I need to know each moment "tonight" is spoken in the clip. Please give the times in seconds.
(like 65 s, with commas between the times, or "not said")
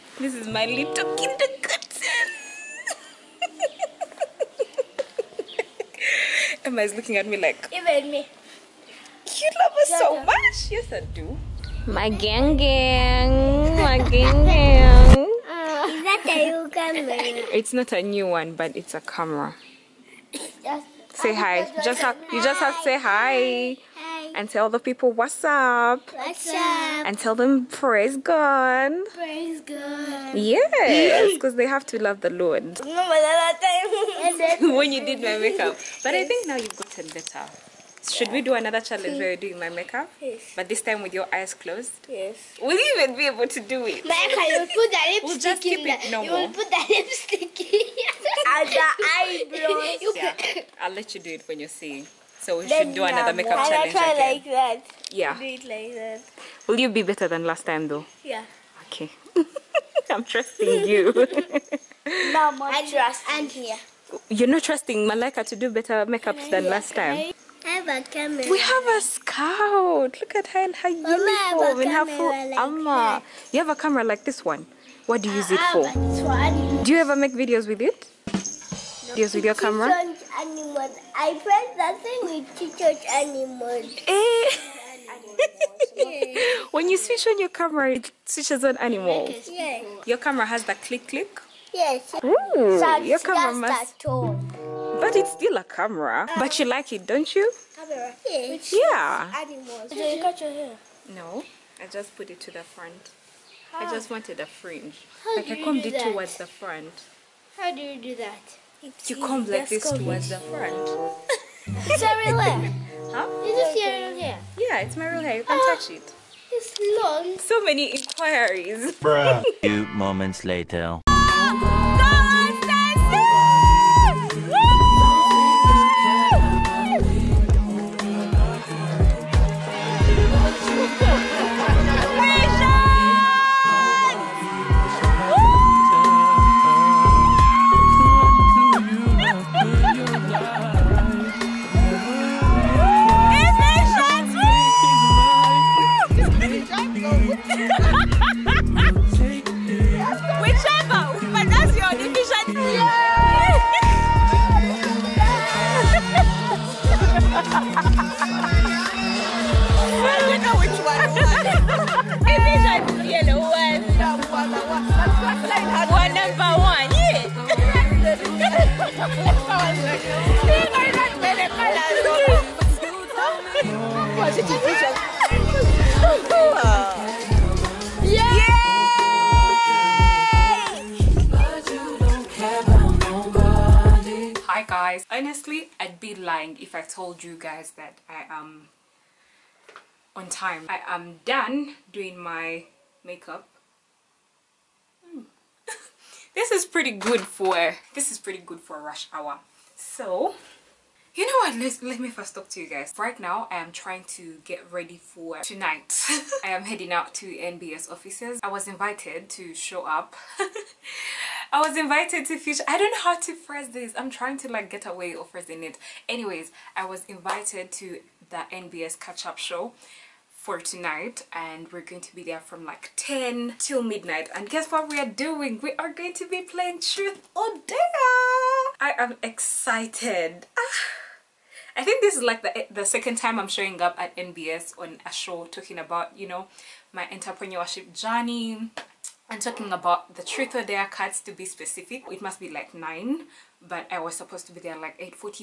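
205 s, 220 s.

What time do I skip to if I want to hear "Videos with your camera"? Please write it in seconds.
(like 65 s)
79 s.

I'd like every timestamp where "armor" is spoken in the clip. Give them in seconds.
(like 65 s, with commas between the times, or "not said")
72 s.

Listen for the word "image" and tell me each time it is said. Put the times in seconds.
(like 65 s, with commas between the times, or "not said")
not said.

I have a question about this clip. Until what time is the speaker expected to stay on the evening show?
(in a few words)
Midnight.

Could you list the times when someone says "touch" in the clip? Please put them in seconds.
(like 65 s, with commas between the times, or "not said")
82 s, 115 s.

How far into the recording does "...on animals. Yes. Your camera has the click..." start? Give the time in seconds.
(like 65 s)
88 s.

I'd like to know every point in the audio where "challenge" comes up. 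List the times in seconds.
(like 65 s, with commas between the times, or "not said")
38 s, 53 s.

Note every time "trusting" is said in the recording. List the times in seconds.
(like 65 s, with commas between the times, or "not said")
60 s, 64 s.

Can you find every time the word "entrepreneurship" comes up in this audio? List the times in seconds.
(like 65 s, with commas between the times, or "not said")
237 s.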